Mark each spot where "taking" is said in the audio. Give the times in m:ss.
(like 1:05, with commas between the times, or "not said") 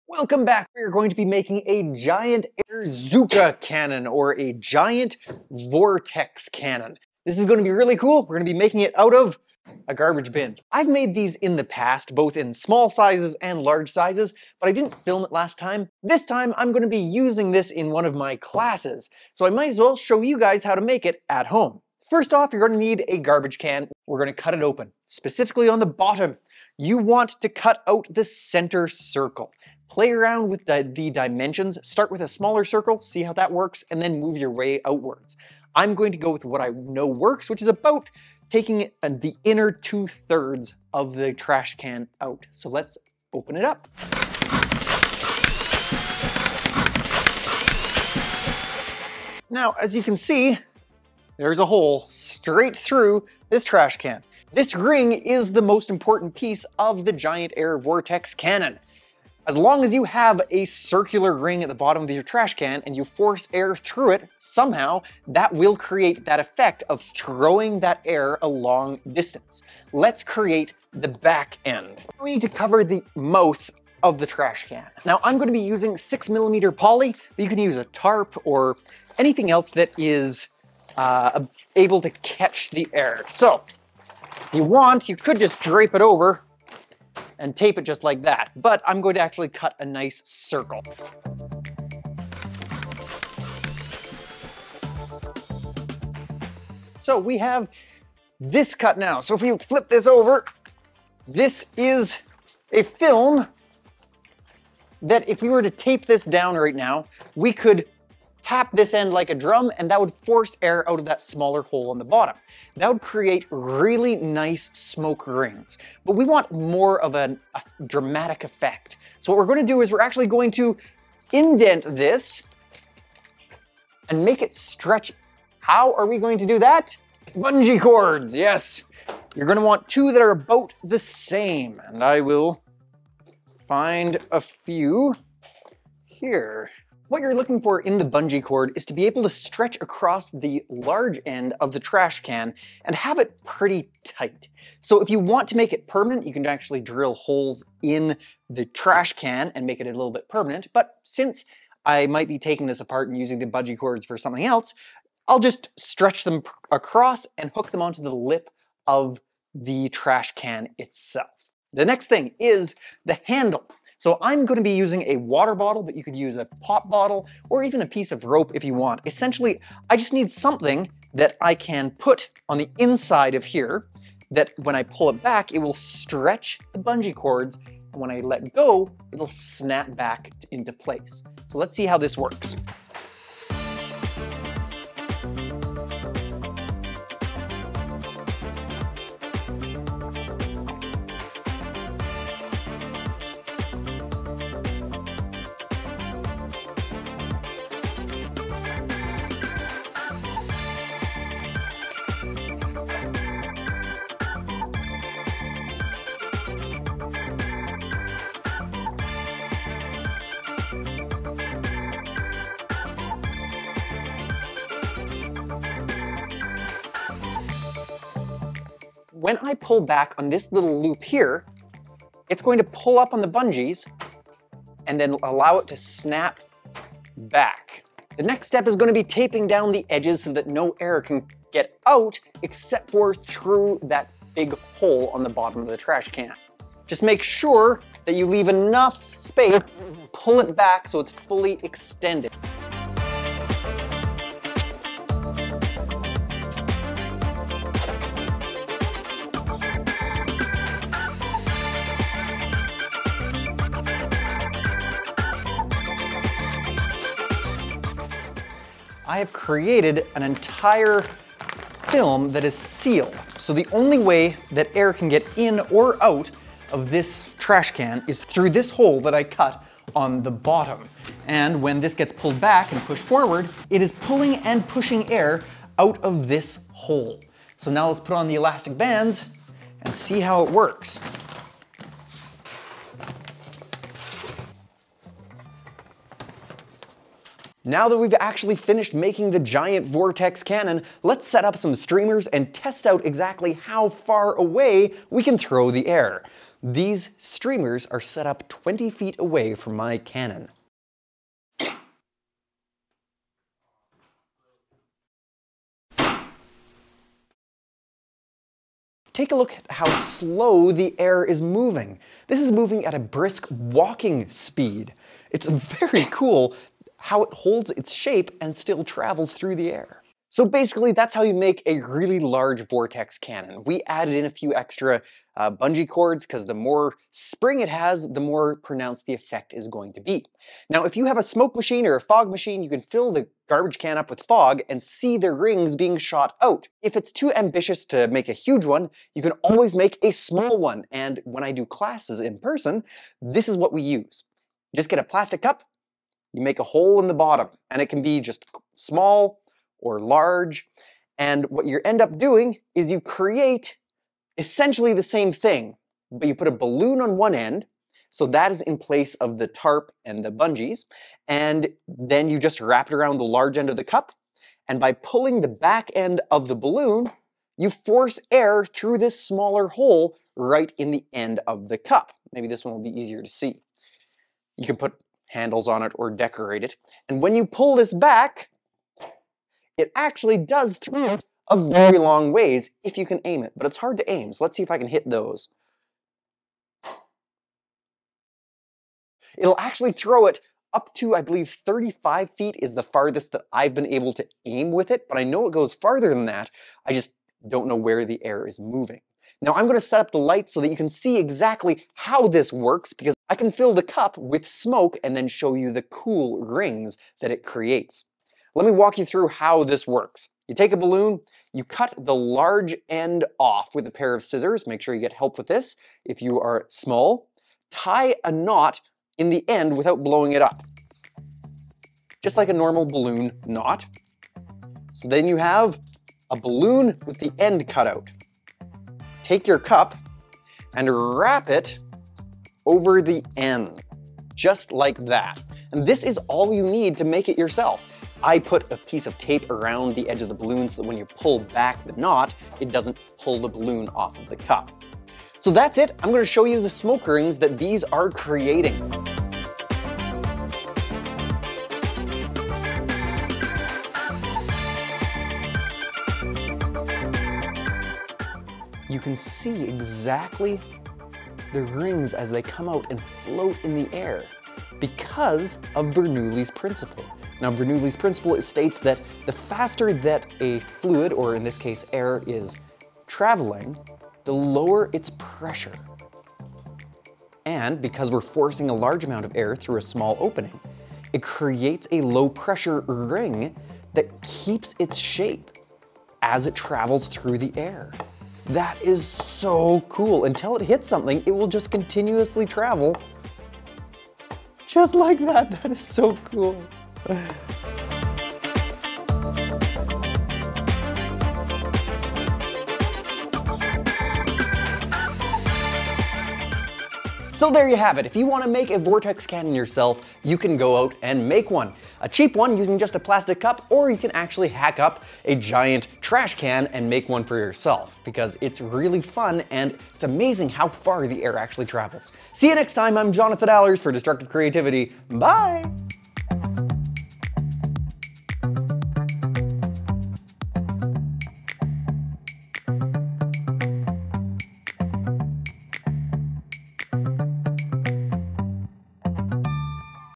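0:38, 2:32.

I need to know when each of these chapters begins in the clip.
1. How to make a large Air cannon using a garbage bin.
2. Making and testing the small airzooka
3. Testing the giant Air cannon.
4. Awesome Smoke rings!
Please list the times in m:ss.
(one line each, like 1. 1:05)
1. 0:40
2. 5:40
3. 4:40
4. 7:27.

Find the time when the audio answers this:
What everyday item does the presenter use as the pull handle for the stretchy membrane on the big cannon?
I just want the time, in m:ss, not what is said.
2:45.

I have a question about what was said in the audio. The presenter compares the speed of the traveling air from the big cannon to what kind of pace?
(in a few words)
brisk walking speed.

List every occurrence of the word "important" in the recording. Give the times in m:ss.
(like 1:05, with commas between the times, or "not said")
0:55.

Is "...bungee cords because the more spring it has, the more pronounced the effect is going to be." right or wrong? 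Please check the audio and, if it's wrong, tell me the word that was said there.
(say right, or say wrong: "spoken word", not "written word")
right.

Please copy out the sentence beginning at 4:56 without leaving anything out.
These streamers are set up 20 feet away from my cannon.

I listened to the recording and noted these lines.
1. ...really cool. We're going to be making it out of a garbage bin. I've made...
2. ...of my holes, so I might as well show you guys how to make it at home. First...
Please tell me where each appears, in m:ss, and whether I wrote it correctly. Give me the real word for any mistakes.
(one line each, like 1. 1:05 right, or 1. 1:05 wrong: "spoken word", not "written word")
1. 0:07 right
2. 0:18 wrong: "classes", not "holes".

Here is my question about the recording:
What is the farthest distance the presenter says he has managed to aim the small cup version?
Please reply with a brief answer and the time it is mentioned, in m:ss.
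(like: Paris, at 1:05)
35 feet, at 6:31.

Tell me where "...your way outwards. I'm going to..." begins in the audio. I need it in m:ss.
0:34.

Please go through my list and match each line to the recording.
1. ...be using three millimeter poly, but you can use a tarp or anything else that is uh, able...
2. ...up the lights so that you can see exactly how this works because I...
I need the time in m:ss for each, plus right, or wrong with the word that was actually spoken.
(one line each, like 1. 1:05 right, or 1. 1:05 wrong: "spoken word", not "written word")
1. 1:15 wrong: "six", not "three"
2. 6:40 right.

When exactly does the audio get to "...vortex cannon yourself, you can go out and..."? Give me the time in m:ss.
8:28.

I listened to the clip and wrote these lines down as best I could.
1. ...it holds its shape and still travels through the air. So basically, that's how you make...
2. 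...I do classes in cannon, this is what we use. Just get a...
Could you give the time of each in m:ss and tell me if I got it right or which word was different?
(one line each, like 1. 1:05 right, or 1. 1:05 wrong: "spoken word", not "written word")
1. 5:17 right
2. 5:41 wrong: "person", not "cannon".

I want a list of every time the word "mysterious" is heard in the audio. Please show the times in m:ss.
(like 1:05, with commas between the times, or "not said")
not said.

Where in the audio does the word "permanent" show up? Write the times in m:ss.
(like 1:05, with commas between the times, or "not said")
2:25, 2:30.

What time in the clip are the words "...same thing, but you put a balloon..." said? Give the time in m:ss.
5:55.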